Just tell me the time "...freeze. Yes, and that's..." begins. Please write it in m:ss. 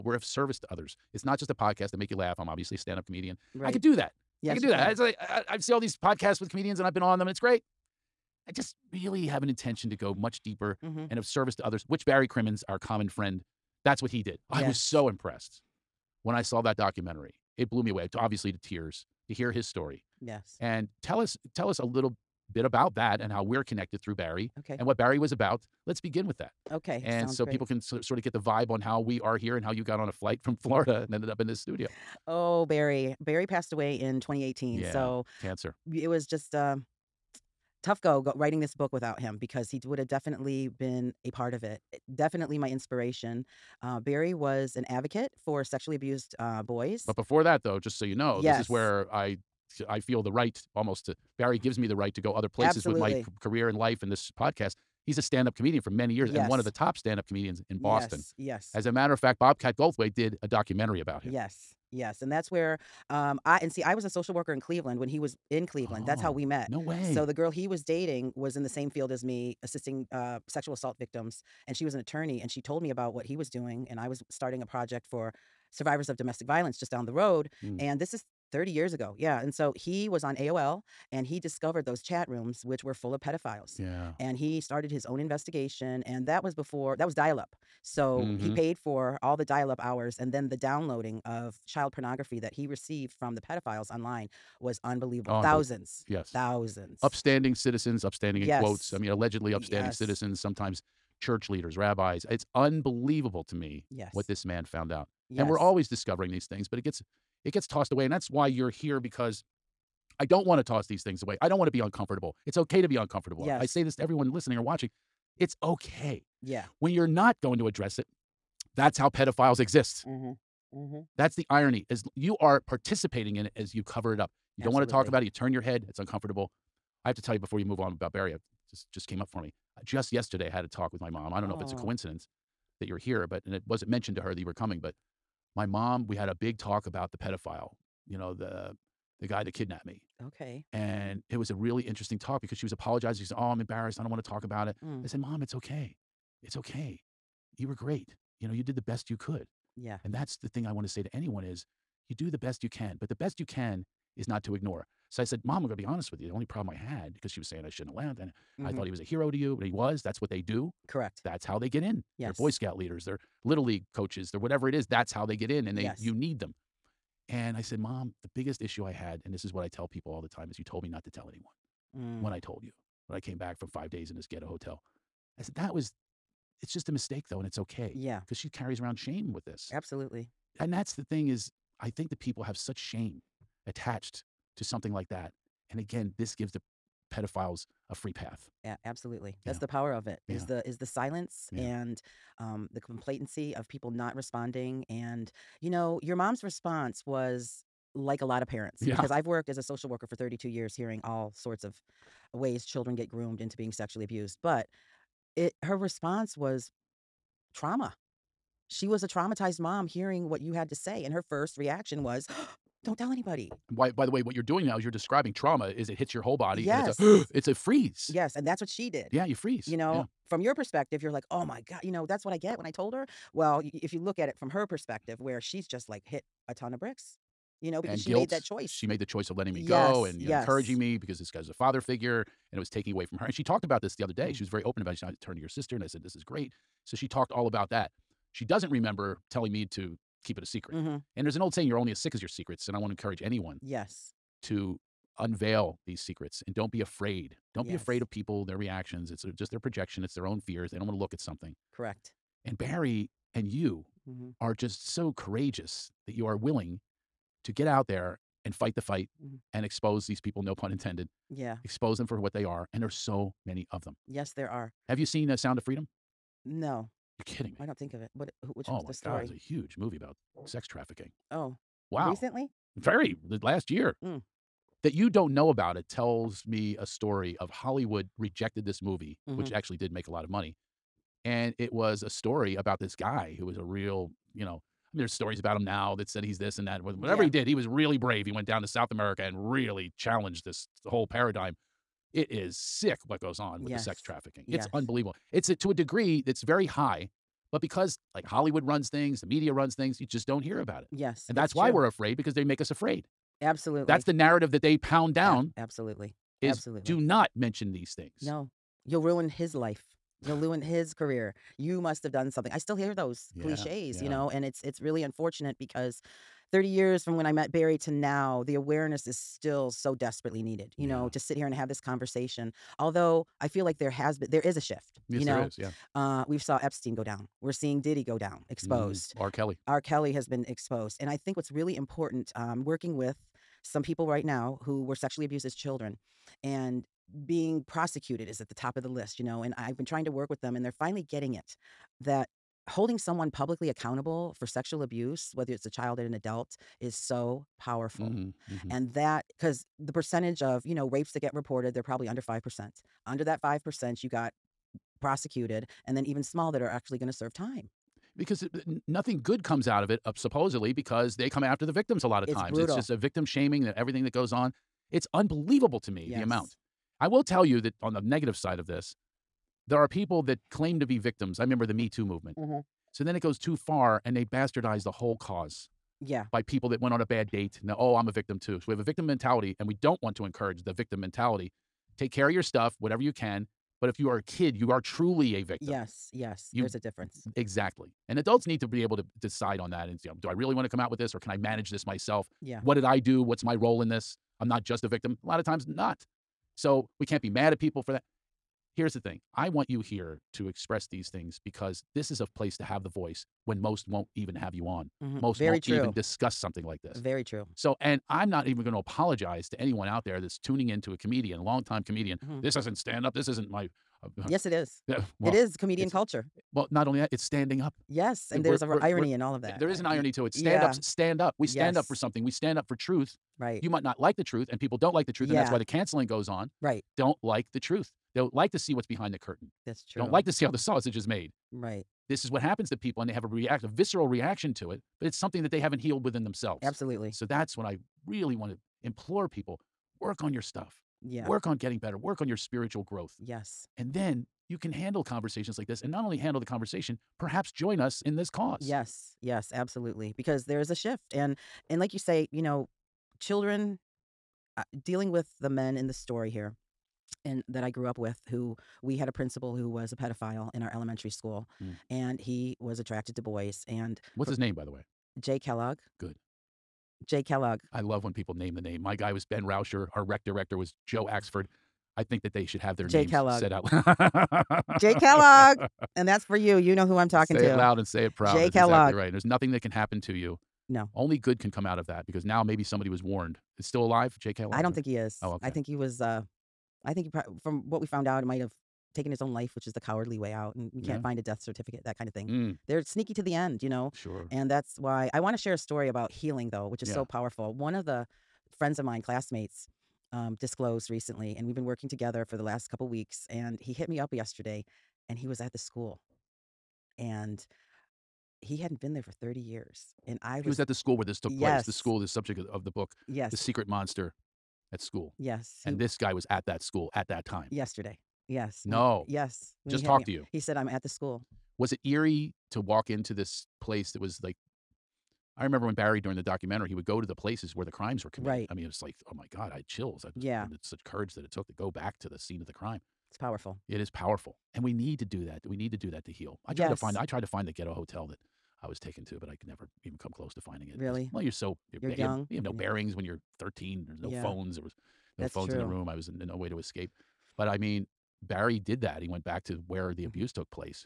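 3:37.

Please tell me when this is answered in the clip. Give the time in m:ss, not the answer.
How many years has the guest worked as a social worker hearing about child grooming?
3:20.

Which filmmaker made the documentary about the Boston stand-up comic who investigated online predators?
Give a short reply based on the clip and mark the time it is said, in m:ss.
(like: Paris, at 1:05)
Bobcat Goldthwait, at 0:59.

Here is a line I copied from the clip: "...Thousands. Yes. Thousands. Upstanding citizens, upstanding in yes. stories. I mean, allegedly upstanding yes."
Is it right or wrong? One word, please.
wrong.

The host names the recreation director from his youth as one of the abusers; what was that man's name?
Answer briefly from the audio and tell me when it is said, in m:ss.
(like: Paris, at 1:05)
Joe Axford, at 7:50.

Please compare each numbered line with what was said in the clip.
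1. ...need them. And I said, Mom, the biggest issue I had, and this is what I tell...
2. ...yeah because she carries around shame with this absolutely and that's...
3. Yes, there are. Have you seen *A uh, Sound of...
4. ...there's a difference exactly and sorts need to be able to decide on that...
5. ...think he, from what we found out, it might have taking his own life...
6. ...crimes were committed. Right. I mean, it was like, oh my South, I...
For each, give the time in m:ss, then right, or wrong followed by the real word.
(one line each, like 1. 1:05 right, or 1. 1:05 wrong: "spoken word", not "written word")
1. 2:46 right
2. 2:57 right
3. 4:24 right
4. 6:26 wrong: "adults", not "sorts"
5. 8:06 right
6. 8:47 wrong: "God", not "South".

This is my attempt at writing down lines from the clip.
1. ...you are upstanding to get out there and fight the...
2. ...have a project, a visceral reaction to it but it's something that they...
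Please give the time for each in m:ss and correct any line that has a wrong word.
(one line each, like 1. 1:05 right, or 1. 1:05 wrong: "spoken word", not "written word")
1. 4:16 wrong: "willing", not "upstanding"
2. 7:13 wrong: "react", not "project".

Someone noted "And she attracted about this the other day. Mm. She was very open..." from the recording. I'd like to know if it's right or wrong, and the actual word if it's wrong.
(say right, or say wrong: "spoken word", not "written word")
wrong: "talked", not "attracted".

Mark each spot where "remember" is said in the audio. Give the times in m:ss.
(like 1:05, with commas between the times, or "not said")
3:58, 6:11, 8:45.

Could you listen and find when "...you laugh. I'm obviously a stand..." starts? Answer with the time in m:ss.
0:02.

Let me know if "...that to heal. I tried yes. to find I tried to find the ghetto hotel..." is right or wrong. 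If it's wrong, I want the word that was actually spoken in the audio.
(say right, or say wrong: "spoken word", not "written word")
right.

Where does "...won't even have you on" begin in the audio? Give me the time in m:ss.
6:43.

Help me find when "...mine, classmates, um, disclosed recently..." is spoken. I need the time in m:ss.
8:18.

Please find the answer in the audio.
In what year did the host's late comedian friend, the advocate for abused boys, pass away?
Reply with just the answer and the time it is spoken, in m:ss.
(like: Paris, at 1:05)
2018, at 0:34.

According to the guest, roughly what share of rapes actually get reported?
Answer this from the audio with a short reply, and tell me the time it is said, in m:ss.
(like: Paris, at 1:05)
under 5%, at 5:52.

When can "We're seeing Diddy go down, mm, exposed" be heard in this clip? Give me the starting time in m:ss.
5:27.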